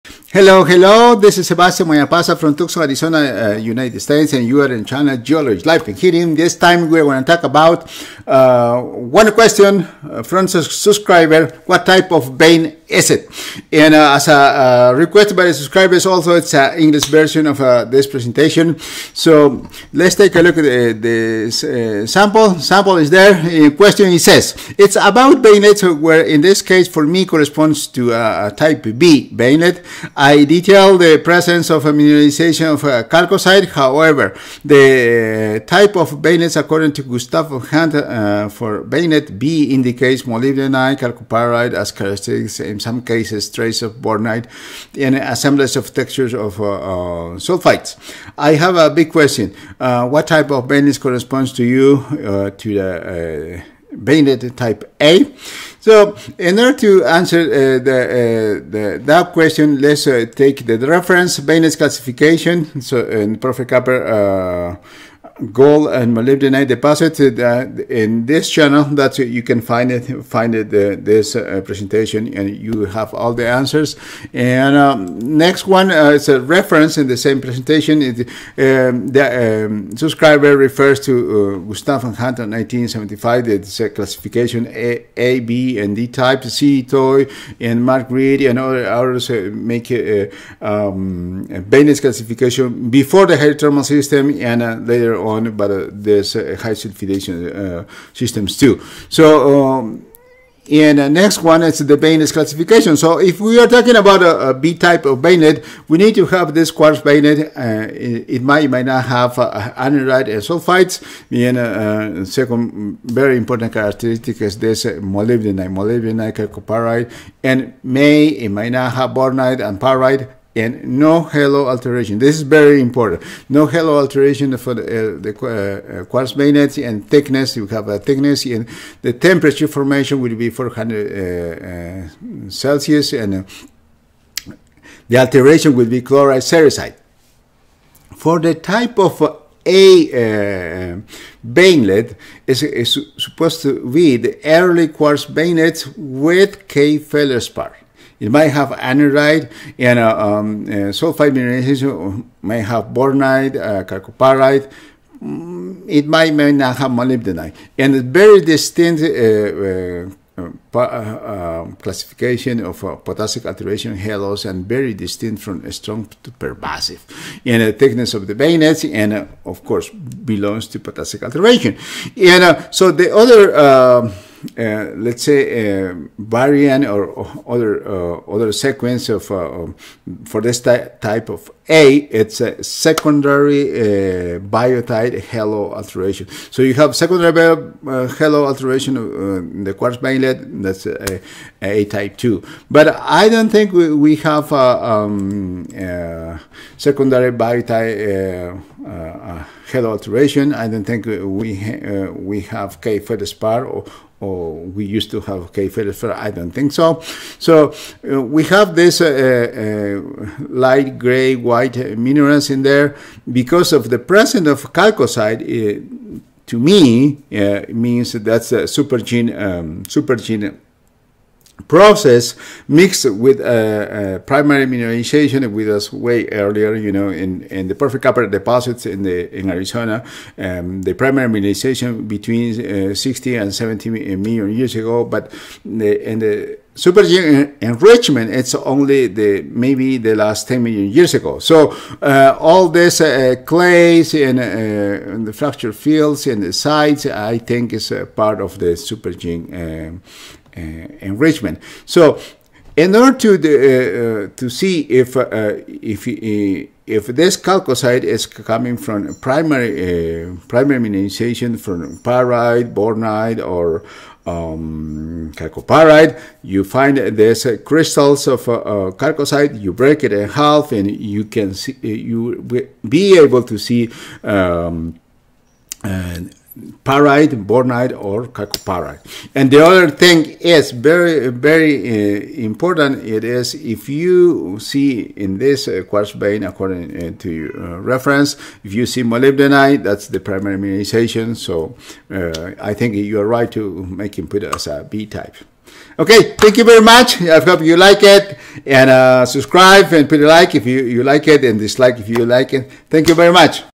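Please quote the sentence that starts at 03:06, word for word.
So you have secondary halo alteration in the quartz veinlet.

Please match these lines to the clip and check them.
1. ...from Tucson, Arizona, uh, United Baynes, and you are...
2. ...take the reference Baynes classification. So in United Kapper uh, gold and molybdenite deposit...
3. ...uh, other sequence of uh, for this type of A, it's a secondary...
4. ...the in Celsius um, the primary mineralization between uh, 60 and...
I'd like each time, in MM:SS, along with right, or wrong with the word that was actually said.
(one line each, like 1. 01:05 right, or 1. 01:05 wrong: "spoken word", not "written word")
1. 00:02 wrong: "States", not "Baynes"
2. 01:00 wrong: "Professor", not "United"
3. 02:57 right
4. 03:49 wrong: "Arizona", not "Celsius".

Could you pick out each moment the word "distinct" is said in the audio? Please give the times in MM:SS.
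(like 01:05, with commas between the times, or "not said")
02:38, 02:44.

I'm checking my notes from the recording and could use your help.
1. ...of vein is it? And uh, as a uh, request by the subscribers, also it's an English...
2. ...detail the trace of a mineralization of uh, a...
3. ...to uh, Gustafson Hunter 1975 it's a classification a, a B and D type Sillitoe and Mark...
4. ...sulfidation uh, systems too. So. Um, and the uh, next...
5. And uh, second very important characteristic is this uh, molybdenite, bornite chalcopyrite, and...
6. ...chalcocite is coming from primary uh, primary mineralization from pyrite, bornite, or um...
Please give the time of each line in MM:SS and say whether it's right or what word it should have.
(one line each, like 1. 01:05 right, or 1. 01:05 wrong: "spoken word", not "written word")
1. 00:12 right
2. 00:30 wrong: "presence", not "trace"
3. 01:20 right
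4. 01:36 right
5. 01:51 wrong: "molybdenite", not "bornite"
6. 04:17 right.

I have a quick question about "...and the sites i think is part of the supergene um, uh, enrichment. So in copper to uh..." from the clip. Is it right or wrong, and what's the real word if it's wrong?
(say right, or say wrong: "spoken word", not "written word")
wrong: "order", not "copper".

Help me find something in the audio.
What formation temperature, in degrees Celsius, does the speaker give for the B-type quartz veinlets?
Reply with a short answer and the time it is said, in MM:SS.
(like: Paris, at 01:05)
400, at 02:10.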